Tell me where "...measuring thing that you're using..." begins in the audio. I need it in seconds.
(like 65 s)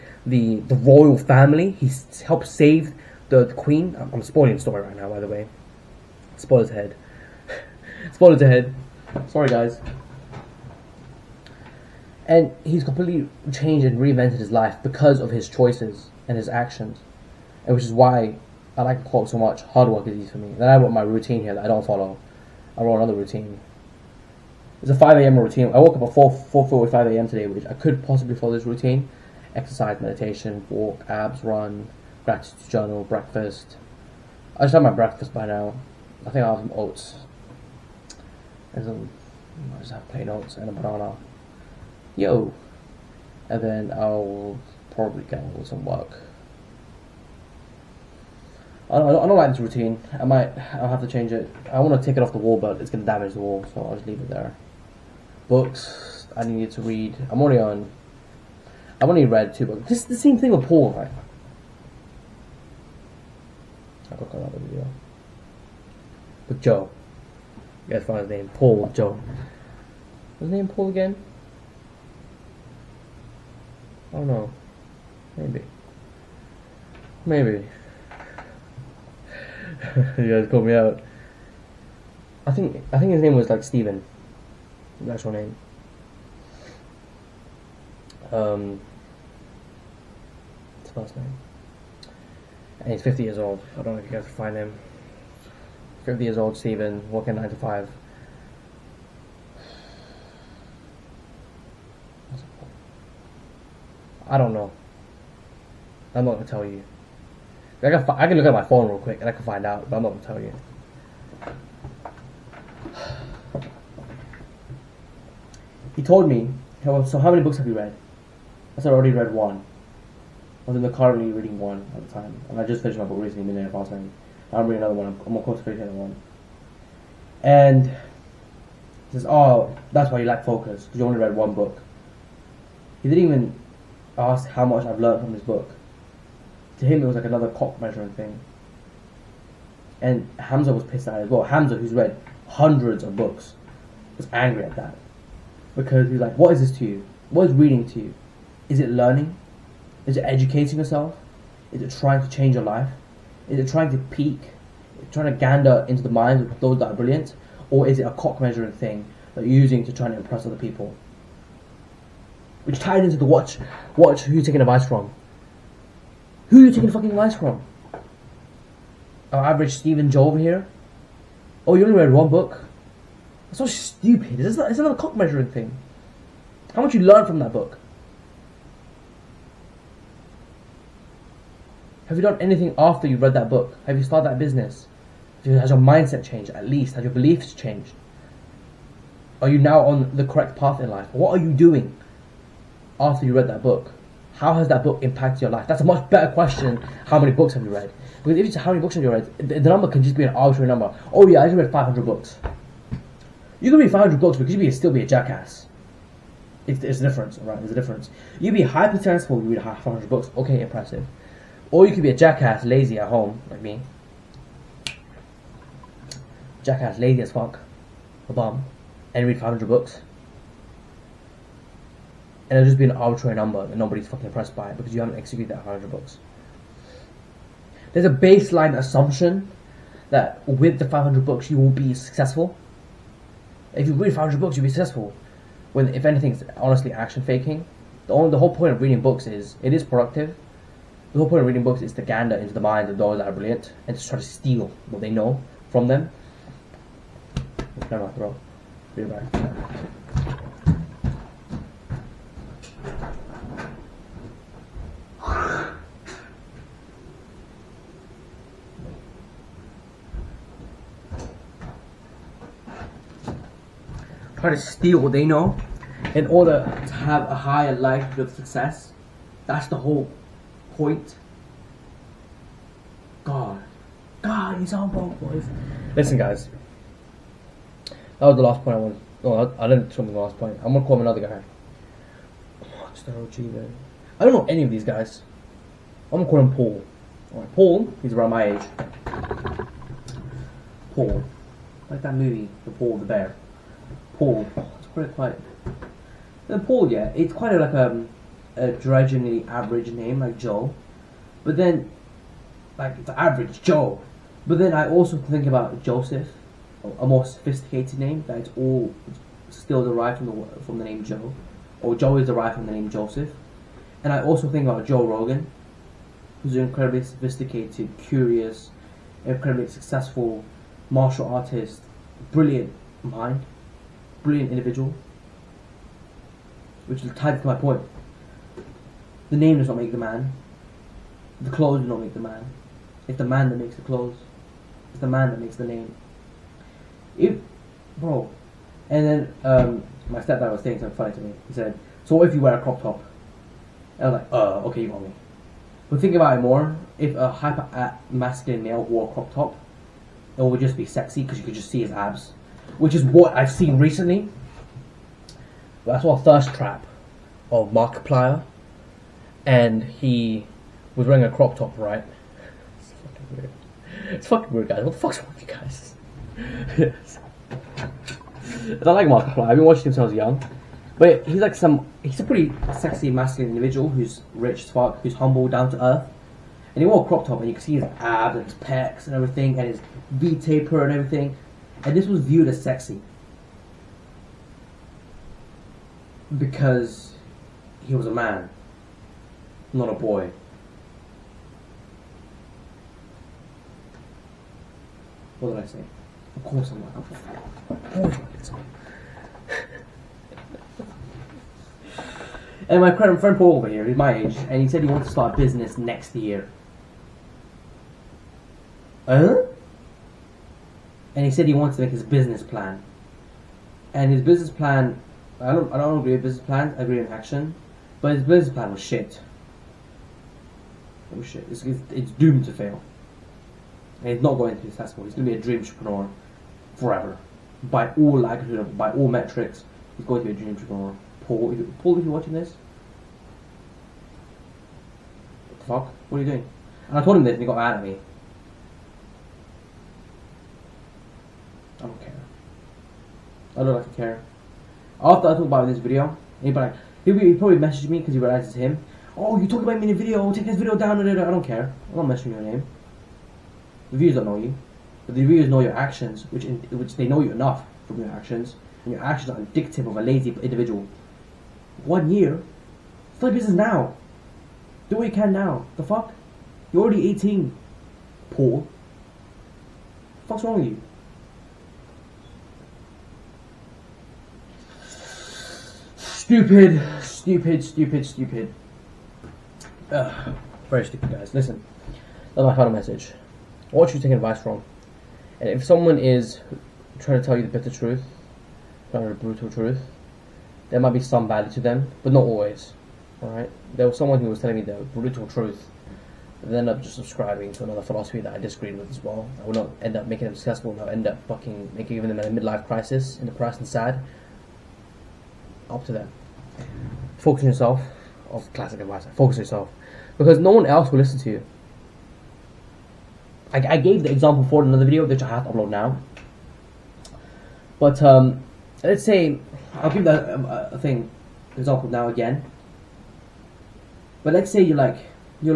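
158 s.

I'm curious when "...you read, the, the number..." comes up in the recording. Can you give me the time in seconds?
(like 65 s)
199 s.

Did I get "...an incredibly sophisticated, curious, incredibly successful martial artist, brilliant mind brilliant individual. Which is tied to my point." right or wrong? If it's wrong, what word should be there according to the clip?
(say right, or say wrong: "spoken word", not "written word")
right.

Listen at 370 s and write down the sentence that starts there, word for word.
But he's like some, he's a pretty sexy, masculine individual who's rich as fuck, who's humble, down to earth.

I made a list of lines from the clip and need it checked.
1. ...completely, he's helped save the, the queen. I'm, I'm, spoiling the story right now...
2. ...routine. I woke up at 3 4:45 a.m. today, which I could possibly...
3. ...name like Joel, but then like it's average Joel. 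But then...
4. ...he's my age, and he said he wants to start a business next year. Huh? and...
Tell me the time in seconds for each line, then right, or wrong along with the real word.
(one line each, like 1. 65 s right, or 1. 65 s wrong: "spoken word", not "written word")
1. 1 s wrong: "family", not "completely"
2. 25 s wrong: "4", not "3"
3. 299 s right
4. 403 s right.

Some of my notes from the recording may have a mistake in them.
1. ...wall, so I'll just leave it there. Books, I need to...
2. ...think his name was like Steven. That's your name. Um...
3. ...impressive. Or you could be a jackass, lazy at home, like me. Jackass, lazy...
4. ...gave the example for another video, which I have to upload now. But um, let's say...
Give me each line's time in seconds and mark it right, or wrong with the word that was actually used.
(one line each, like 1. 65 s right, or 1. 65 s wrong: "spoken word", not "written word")
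1. 53 s right
2. 82 s right
3. 210 s right
4. 513 s right.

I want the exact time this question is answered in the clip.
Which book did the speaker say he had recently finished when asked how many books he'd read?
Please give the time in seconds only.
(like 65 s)
123 s.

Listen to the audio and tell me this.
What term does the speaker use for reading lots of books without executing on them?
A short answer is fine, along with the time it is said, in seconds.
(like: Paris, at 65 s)
action faking, at 236 s.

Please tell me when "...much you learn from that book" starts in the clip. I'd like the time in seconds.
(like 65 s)
176 s.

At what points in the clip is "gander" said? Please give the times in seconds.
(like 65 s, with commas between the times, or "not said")
155 s, 242 s.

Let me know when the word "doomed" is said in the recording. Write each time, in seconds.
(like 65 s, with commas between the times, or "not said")
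422 s.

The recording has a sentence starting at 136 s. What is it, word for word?
To him, it was like another cock measuring thing.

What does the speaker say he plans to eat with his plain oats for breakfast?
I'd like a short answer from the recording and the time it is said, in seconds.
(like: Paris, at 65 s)
a banana, at 40 s.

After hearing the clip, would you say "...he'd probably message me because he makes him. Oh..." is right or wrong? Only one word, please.
wrong.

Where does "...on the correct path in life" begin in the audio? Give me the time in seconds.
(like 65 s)
189 s.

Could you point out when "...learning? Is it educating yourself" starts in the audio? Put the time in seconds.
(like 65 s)
148 s.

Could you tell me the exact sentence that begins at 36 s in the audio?
I think I'll have some oats.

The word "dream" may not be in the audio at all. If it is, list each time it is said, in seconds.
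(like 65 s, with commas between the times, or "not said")
425 s, 430 s.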